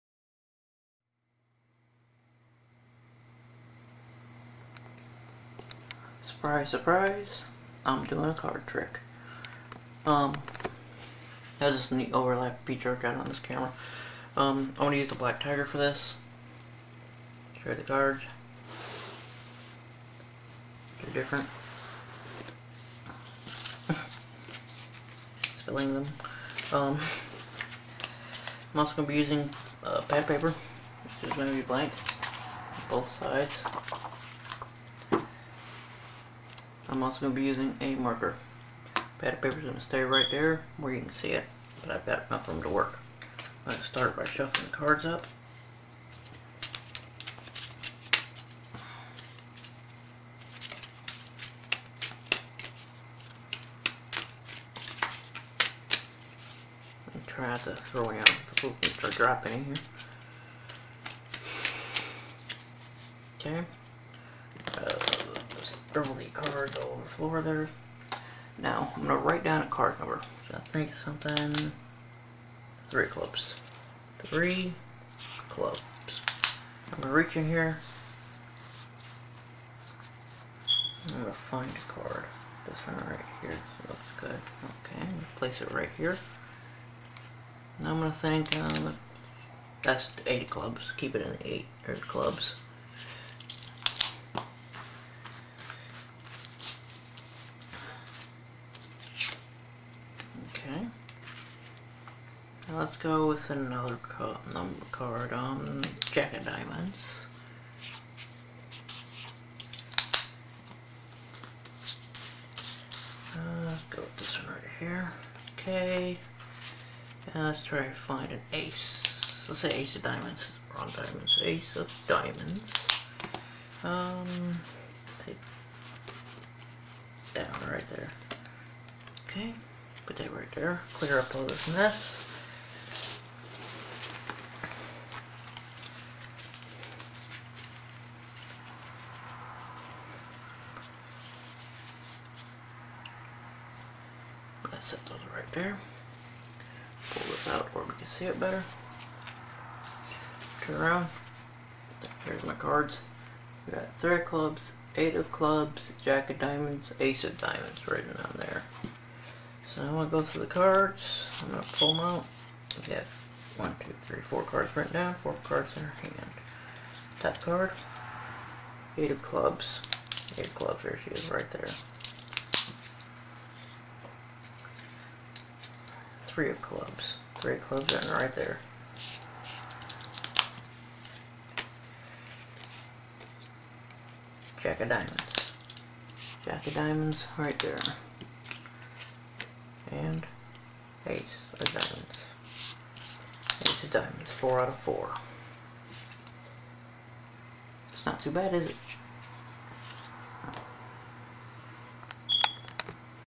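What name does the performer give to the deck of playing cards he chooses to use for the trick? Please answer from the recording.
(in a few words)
Black Tiger.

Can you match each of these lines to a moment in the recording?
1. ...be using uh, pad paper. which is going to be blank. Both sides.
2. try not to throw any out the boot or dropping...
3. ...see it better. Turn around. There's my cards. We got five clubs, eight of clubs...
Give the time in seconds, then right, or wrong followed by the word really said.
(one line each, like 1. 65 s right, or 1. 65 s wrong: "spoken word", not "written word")
1. 29 s right
2. 57 s right
3. 148 s wrong: "three", not "five".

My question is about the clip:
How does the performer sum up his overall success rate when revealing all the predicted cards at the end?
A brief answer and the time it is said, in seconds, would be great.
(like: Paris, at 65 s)
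four out of four, at 194 s.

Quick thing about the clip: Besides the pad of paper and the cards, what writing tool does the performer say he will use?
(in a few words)
a marker.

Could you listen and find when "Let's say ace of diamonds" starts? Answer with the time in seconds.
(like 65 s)
119 s.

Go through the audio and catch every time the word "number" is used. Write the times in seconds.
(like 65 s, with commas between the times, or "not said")
69 s, 104 s.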